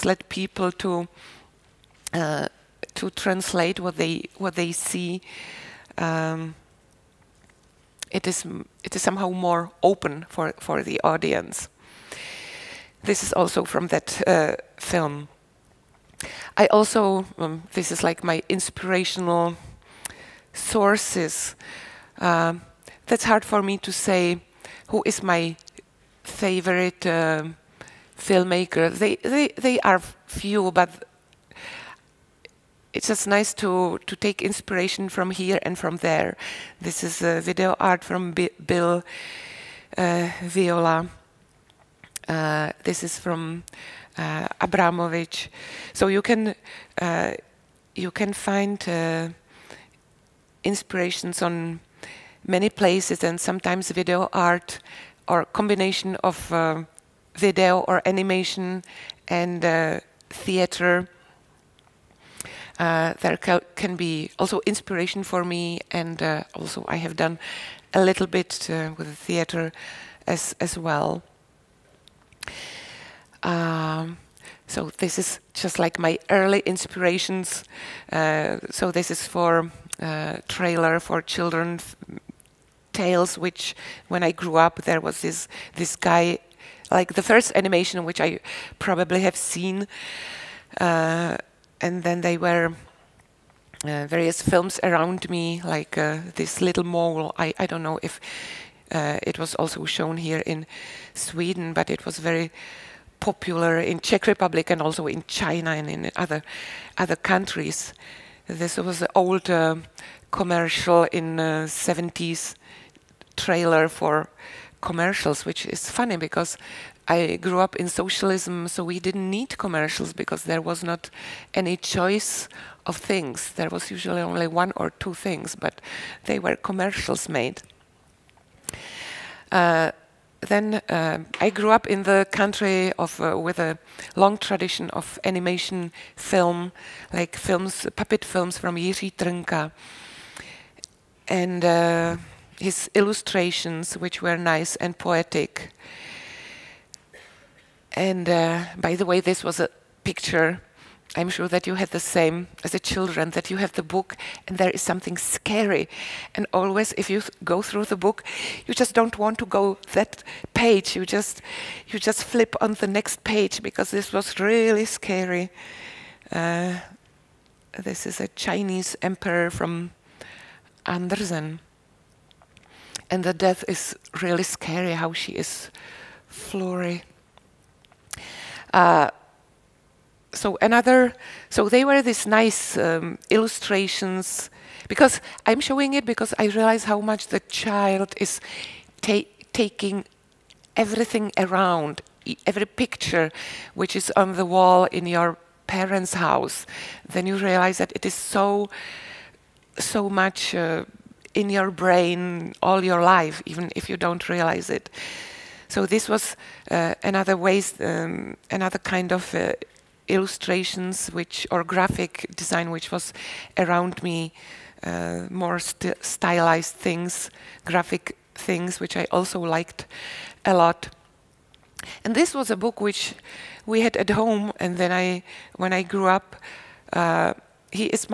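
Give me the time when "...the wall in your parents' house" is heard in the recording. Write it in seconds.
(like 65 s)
194 s.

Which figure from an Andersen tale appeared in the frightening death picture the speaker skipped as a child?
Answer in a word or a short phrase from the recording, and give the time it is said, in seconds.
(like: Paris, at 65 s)
Chinese emperor, at 168 s.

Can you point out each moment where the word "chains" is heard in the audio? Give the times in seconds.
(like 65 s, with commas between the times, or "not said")
not said.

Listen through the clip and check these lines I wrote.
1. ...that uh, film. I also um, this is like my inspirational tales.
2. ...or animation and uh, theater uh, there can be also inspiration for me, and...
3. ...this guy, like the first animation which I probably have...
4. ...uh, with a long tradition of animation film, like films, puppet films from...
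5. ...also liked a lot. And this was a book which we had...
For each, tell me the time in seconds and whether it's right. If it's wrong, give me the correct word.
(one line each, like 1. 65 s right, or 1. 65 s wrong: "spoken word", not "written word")
1. 13 s wrong: "sources", not "tales"
2. 57 s right
3. 85 s right
4. 133 s right
5. 219 s right.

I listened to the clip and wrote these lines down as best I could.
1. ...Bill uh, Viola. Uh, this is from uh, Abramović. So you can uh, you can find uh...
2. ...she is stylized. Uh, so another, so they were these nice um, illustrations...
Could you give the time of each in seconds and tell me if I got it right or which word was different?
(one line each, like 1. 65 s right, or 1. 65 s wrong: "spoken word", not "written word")
1. 38 s right
2. 175 s wrong: "flurried", not "stylized".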